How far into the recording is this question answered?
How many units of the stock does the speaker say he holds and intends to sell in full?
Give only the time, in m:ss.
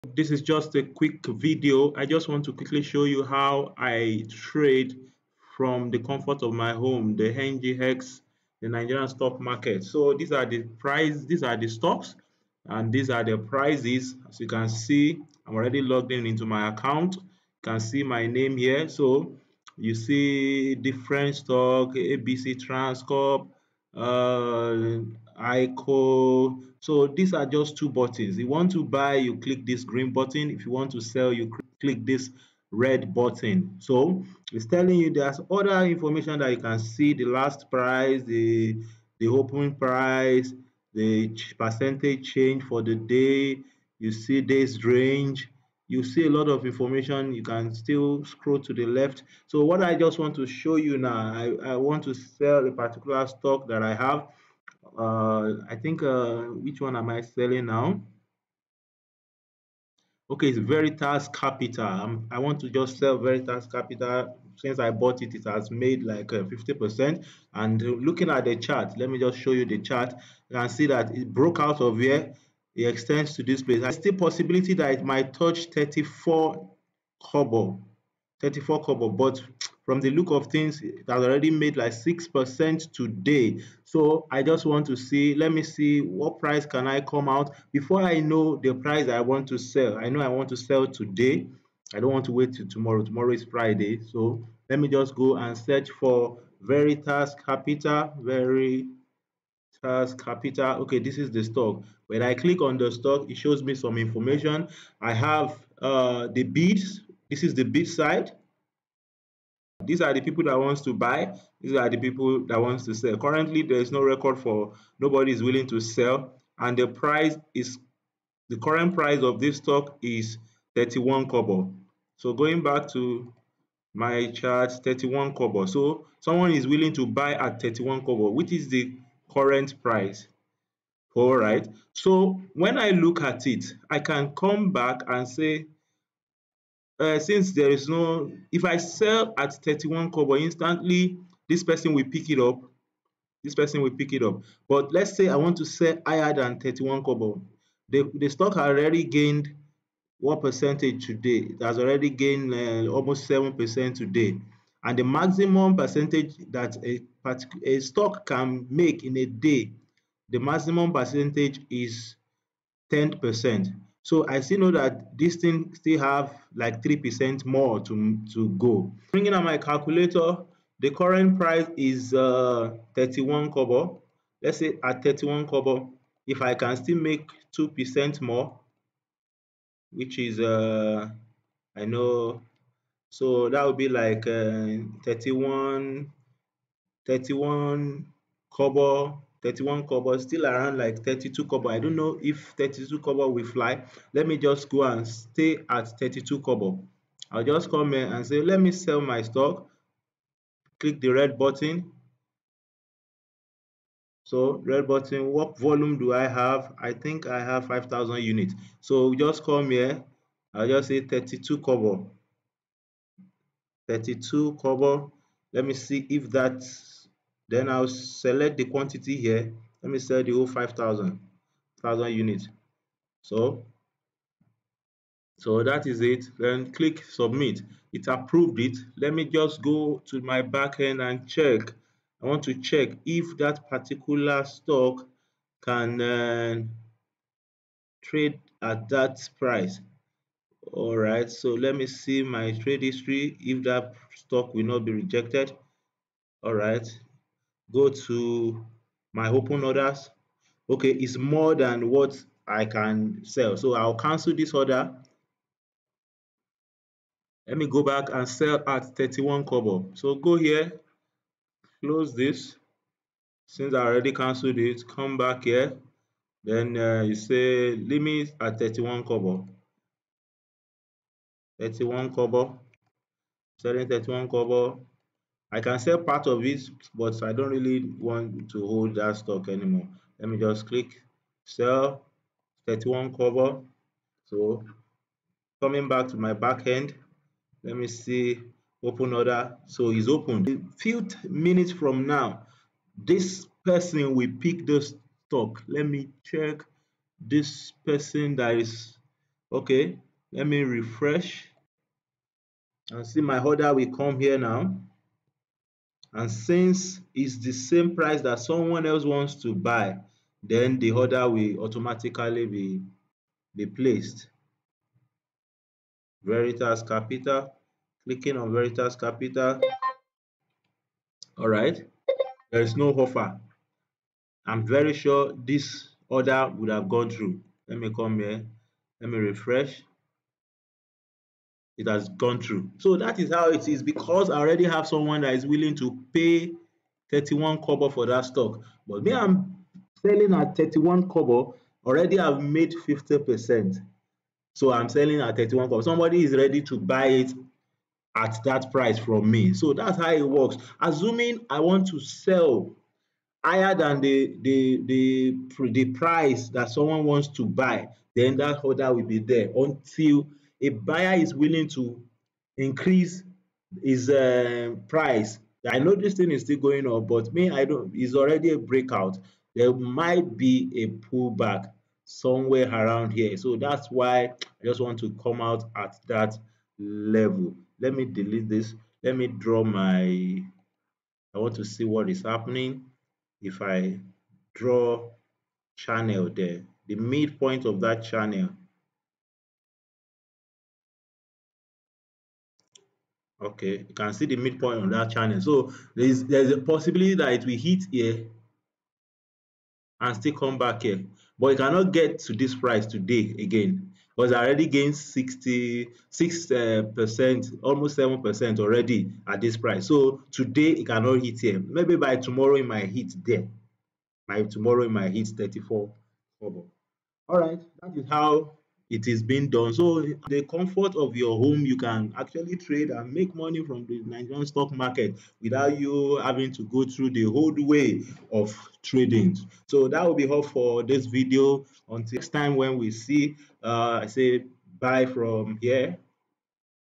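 3:26.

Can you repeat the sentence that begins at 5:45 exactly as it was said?
Somebody is ready to buy it at that price from me.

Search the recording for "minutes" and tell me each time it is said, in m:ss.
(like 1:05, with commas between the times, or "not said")
4:51.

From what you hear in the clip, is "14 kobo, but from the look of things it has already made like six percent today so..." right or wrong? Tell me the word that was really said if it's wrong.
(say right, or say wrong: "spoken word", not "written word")
wrong: "34", not "14".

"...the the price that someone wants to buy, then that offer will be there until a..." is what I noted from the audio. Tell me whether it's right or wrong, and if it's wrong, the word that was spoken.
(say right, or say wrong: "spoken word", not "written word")
wrong: "order", not "offer".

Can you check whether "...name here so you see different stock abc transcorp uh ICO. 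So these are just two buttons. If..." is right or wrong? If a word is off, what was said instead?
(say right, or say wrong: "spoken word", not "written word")
right.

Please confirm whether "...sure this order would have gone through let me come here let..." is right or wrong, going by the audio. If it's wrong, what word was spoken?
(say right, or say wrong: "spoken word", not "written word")
right.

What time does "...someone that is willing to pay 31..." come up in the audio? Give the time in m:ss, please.
5:34.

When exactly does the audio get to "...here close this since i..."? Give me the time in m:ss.
4:20.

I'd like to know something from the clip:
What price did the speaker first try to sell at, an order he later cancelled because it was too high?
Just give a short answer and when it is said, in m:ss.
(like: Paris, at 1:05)
32 kobo, at 3:30.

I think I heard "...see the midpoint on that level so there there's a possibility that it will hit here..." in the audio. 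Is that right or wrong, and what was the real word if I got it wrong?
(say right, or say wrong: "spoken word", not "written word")
wrong: "channel", not "level".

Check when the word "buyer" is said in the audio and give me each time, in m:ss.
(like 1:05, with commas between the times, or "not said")
6:00.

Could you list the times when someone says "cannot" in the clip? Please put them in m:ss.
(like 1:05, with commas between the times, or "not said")
6:41, 6:50.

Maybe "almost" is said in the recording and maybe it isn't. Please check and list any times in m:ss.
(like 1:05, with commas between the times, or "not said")
2:32, 6:47.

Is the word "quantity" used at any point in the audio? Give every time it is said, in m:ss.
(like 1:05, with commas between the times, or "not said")
3:38.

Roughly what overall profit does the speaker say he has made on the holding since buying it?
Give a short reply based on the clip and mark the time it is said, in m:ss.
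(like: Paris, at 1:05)
50%, at 1:05.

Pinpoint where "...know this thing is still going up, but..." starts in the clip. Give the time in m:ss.
6:05.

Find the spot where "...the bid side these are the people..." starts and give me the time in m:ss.
1:47.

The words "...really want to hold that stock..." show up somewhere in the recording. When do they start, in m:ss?
4:37.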